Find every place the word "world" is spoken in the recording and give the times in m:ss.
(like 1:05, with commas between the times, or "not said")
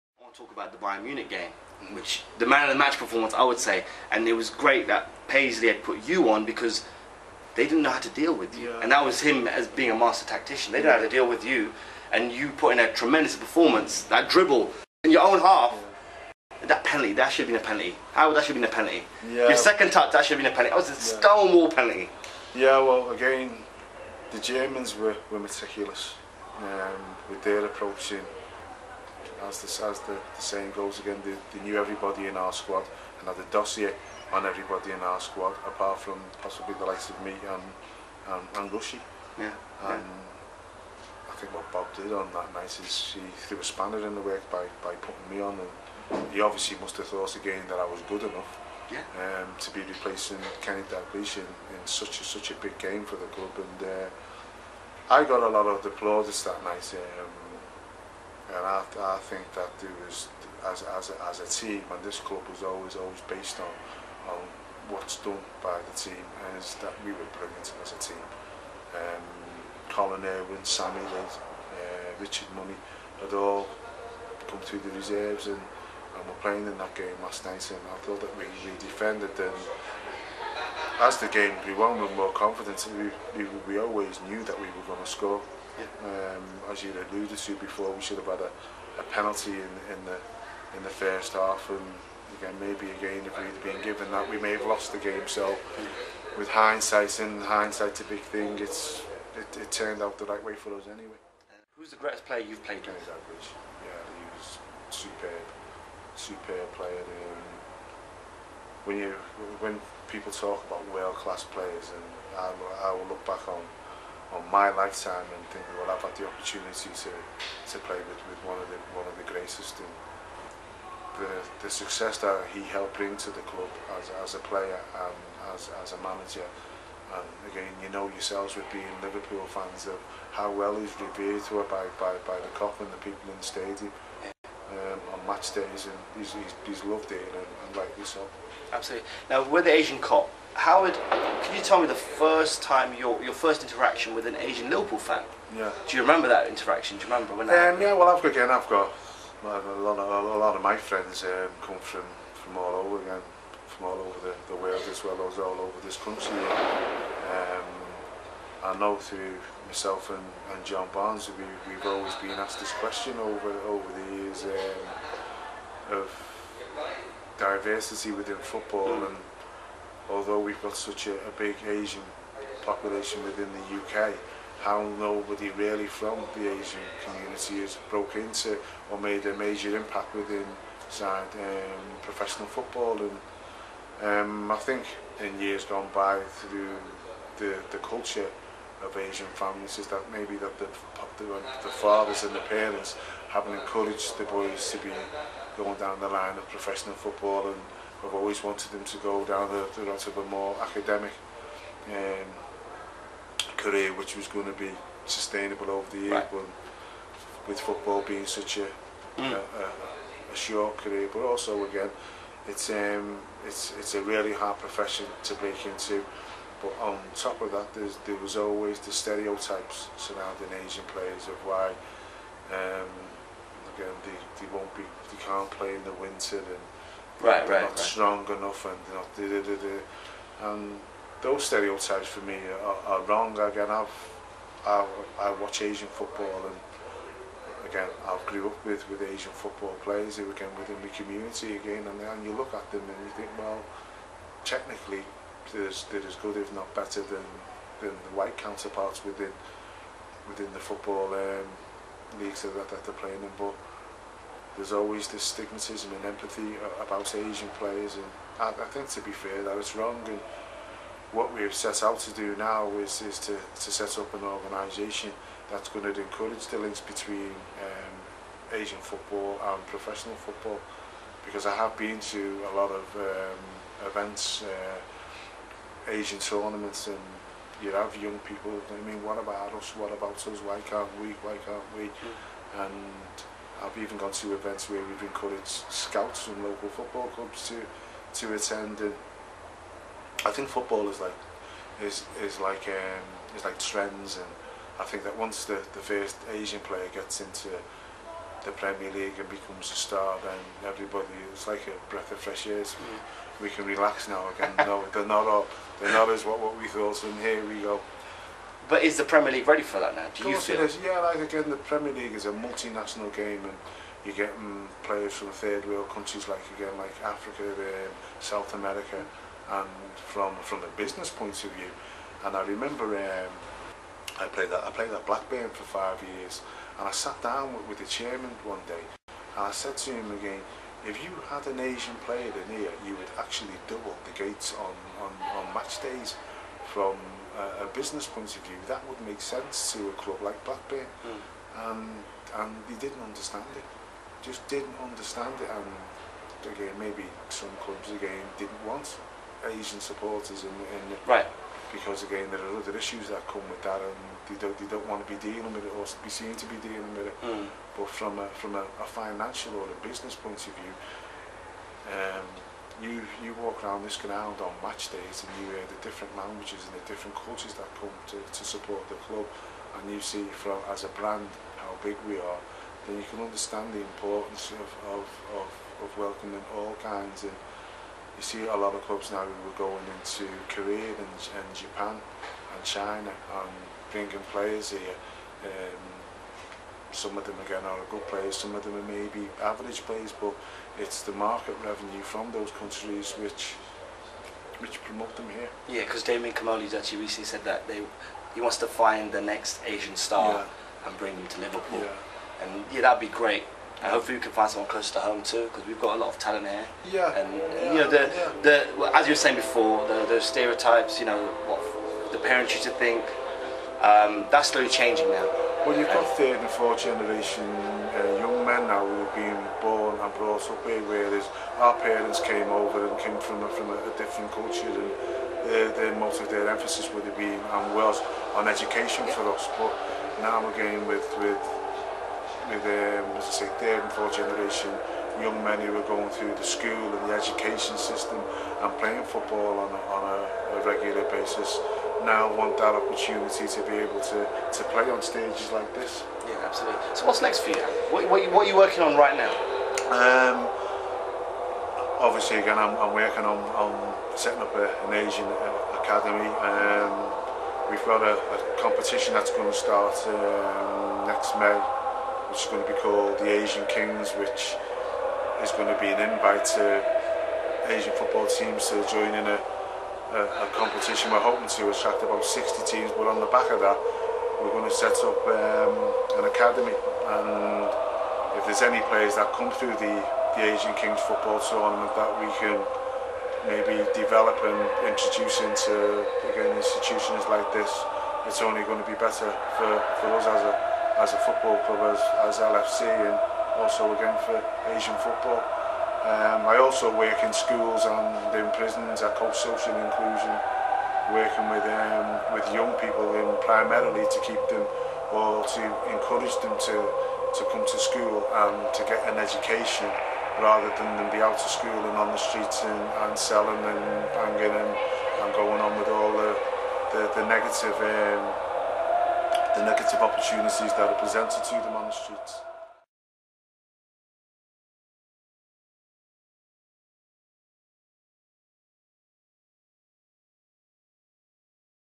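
1:50, 2:34, 5:15.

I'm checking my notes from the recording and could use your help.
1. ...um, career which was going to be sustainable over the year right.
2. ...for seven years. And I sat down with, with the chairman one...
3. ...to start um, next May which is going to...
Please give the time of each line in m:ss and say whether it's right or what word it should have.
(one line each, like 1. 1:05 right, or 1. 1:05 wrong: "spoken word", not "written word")
1. 3:21 right
2. 5:25 wrong: "five", not "seven"
3. 7:39 right.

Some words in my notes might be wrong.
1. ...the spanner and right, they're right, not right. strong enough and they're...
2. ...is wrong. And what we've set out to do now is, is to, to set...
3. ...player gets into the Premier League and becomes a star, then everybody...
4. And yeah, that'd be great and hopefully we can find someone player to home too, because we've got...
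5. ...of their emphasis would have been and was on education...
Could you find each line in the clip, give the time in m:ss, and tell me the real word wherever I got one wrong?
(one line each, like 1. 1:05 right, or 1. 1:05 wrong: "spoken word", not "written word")
1. 3:45 wrong: "winter", not "spanner"
2. 4:19 right
3. 4:56 right
4. 6:42 wrong: "closer", not "player"
5. 7:06 right.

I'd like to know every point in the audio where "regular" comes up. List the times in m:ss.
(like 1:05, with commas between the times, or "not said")
7:20.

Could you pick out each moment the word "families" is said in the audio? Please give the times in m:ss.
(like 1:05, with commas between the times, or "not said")
3:09.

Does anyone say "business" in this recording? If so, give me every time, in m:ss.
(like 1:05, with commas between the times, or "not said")
5:20, 5:37, 5:59.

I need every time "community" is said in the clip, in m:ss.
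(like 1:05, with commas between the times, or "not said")
2:57, 4:00.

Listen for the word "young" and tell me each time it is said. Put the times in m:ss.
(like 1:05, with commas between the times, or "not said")
4:38, 6:58, 7:15, 8:22.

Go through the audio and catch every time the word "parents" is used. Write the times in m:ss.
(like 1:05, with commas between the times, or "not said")
3:12, 6:52, 7:01.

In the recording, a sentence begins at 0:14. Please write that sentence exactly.
That dribble in your own half.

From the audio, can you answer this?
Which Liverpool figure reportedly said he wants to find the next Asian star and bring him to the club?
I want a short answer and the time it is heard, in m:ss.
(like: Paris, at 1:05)
Damien Comolli, at 6:36.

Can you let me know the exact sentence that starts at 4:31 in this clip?
Because I have been to a lot of um, events.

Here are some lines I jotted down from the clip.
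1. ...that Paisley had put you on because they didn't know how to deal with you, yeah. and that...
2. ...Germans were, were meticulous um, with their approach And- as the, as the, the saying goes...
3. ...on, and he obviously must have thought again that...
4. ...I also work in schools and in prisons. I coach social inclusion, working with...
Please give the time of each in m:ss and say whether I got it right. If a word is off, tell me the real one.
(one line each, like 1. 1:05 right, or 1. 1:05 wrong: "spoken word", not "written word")
1. 0:04 right
2. 0:24 right
3. 0:45 right
4. 8:16 right.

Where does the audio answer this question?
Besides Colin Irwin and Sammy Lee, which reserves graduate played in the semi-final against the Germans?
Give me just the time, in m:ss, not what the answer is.
1:12.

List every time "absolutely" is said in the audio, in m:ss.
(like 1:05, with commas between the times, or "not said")
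2:18, 7:26.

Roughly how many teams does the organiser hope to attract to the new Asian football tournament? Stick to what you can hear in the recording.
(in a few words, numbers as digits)
60.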